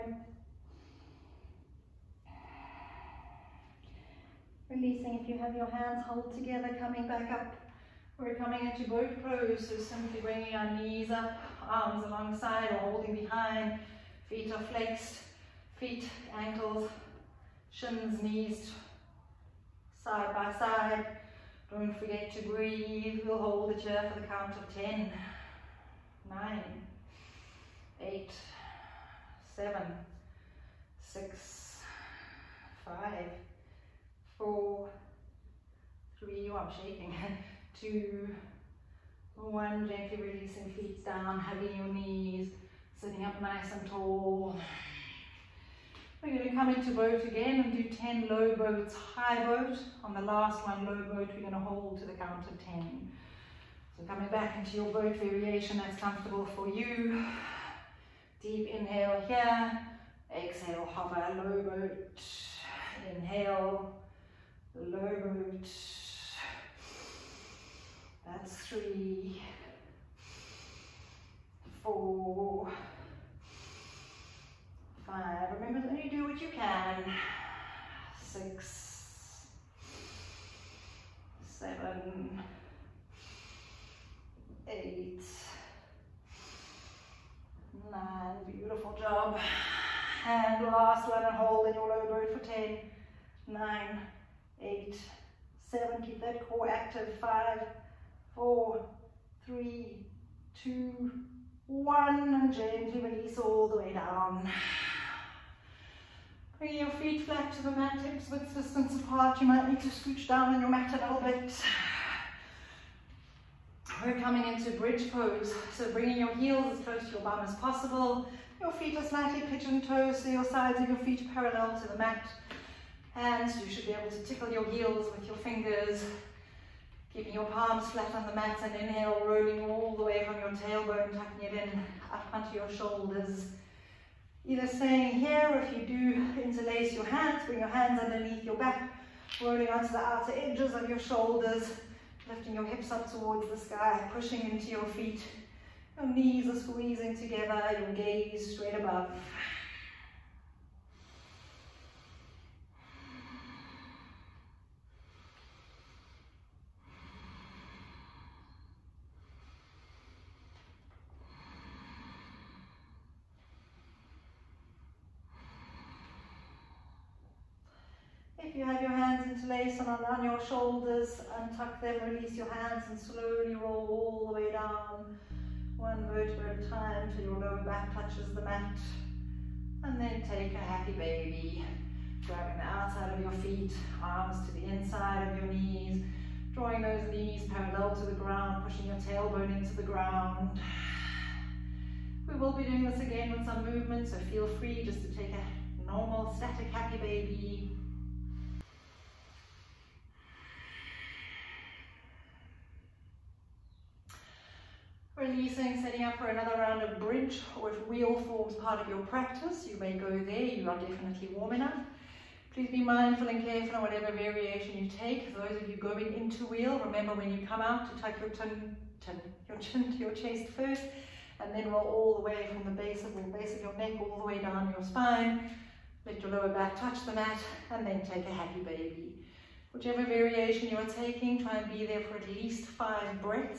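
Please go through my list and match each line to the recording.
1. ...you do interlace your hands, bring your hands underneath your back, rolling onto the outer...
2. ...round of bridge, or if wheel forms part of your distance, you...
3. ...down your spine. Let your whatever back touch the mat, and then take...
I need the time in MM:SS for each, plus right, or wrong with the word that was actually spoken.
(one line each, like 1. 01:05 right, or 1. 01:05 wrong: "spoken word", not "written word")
1. 02:15 right
2. 03:26 wrong: "practice", not "distance"
3. 03:44 wrong: "lower", not "whatever".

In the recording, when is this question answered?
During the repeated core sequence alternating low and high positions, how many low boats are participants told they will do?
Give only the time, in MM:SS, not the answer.
00:47.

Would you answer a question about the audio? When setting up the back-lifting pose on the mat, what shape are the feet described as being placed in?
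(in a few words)
Slightly pigeon toes.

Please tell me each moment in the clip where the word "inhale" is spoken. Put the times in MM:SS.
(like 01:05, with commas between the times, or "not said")
00:58, 01:03, 02:08.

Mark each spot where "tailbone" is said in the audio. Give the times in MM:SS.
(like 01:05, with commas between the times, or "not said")
02:10, 03:08.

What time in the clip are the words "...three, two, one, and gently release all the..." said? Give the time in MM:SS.
01:39.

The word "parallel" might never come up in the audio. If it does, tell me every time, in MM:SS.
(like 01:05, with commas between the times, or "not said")
02:01, 03:07.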